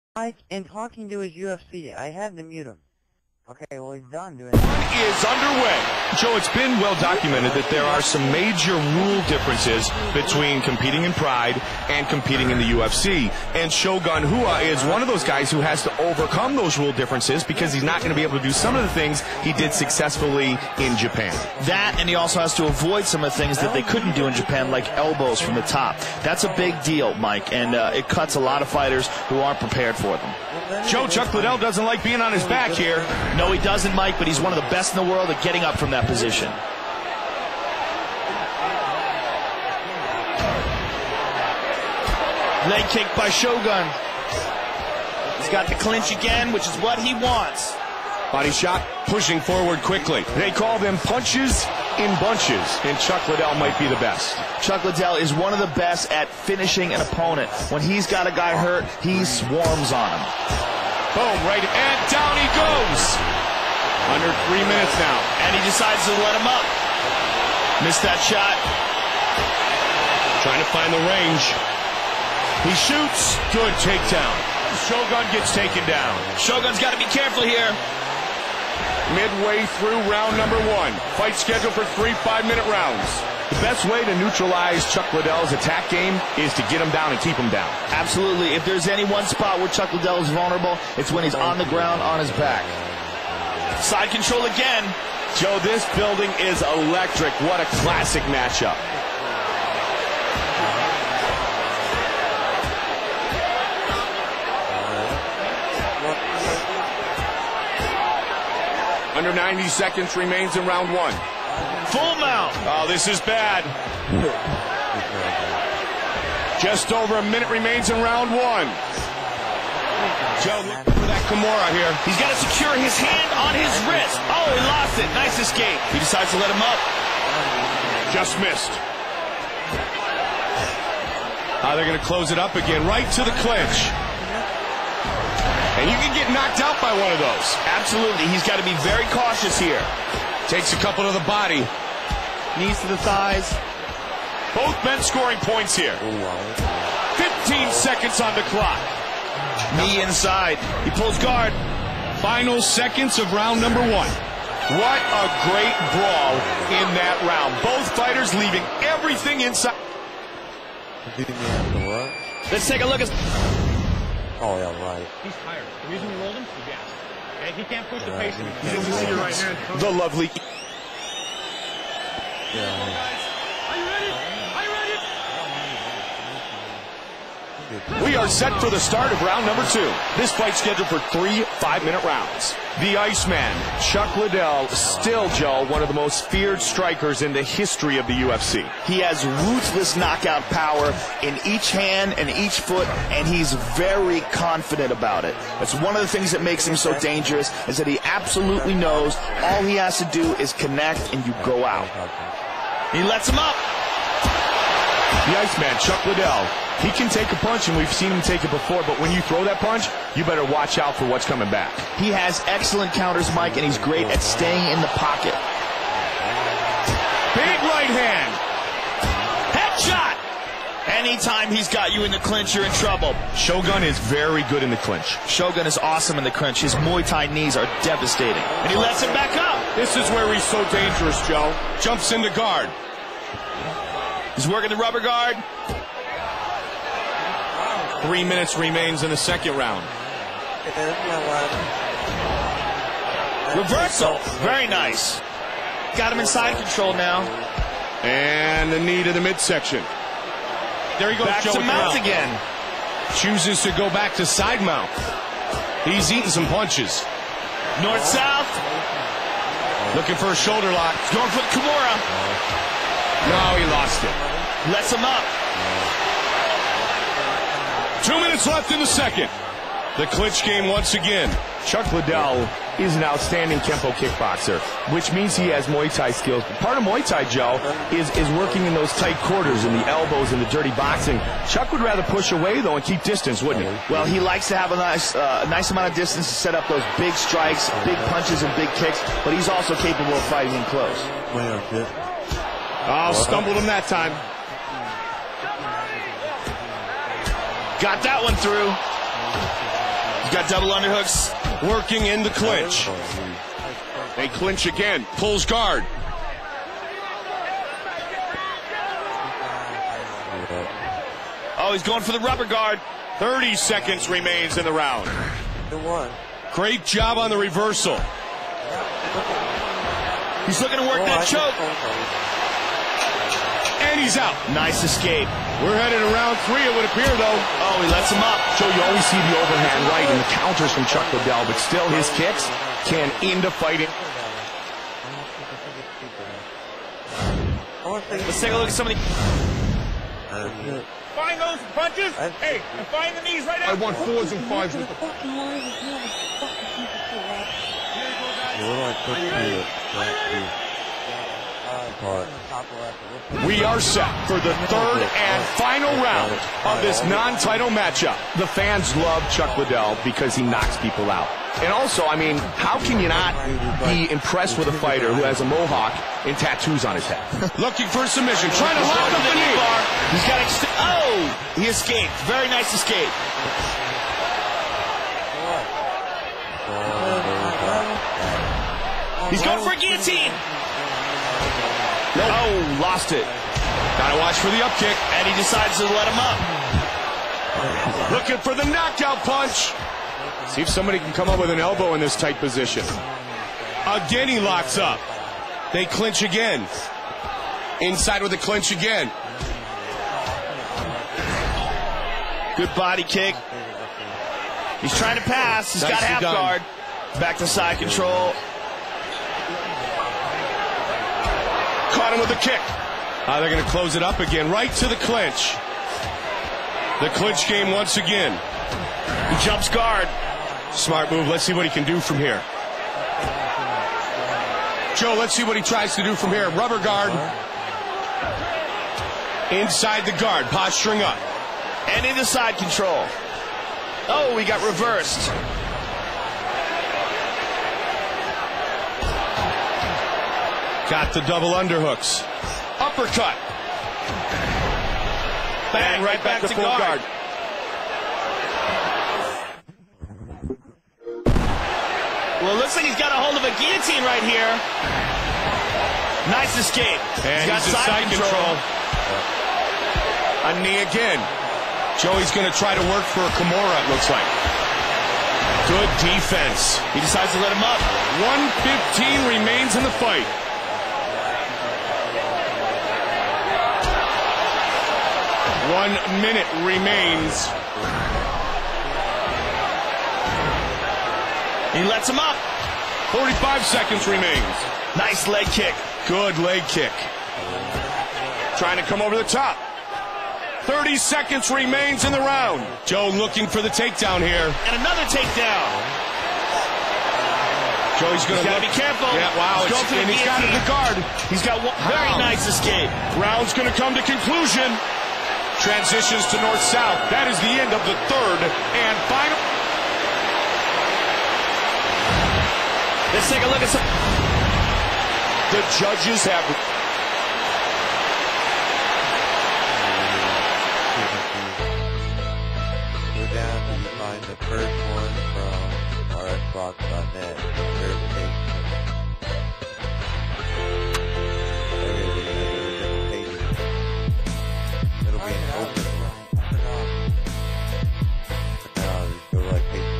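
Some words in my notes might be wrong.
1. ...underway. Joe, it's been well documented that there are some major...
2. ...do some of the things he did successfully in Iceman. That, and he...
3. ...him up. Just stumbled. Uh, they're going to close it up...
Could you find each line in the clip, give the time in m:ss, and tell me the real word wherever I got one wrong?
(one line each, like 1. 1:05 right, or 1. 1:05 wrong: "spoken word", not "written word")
1. 0:05 right
2. 0:18 wrong: "Japan", not "Iceman"
3. 2:06 wrong: "missed", not "stumbled".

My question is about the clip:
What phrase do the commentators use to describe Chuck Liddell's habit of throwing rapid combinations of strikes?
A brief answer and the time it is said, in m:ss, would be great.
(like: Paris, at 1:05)
punches in bunches, at 0:50.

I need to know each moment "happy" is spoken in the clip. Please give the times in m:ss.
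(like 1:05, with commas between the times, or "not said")
not said.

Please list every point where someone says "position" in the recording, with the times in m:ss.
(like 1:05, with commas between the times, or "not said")
0:36, 6:32.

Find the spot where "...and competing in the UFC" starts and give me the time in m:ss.
0:11.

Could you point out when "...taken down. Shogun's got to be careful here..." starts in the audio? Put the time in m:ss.
1:15.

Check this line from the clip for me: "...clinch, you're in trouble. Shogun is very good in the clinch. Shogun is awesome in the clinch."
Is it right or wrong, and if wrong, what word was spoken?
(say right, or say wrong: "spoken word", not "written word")
right.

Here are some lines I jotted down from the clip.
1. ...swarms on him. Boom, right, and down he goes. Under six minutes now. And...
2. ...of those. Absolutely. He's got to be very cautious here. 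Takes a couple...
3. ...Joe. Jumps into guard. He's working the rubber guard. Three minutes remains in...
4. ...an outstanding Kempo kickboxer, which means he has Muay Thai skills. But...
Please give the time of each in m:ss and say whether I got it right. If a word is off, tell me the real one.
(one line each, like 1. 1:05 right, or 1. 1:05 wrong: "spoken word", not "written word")
1. 0:59 wrong: "three", not "six"
2. 2:17 right
3. 3:51 right
4. 4:32 right.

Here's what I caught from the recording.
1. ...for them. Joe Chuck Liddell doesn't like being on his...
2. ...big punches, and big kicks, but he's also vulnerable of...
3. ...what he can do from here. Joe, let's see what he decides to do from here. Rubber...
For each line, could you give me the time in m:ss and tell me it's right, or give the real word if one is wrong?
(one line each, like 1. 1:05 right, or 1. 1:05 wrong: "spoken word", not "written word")
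1. 0:29 right
2. 4:47 wrong: "capable", not "vulnerable"
3. 7:01 wrong: "tries", not "decides".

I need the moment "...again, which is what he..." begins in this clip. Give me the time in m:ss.
0:46.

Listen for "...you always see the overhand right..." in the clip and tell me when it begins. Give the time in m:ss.
5:28.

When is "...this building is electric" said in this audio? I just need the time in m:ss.
1:35.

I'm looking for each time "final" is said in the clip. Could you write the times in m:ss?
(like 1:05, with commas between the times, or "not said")
2:32, 5:55, 8:29.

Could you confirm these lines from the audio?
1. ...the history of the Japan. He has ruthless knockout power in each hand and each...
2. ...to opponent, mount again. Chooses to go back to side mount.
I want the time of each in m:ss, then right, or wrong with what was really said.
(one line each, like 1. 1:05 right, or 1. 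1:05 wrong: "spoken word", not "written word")
1. 3:07 wrong: "UFC", not "Japan"
2. 4:11 wrong: "mount", not "opponent".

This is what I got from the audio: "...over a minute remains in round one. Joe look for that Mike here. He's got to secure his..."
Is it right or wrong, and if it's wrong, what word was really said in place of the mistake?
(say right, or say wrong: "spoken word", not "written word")
wrong: "Kimura", not "Mike".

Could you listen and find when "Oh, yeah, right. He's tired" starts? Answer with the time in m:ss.
2:44.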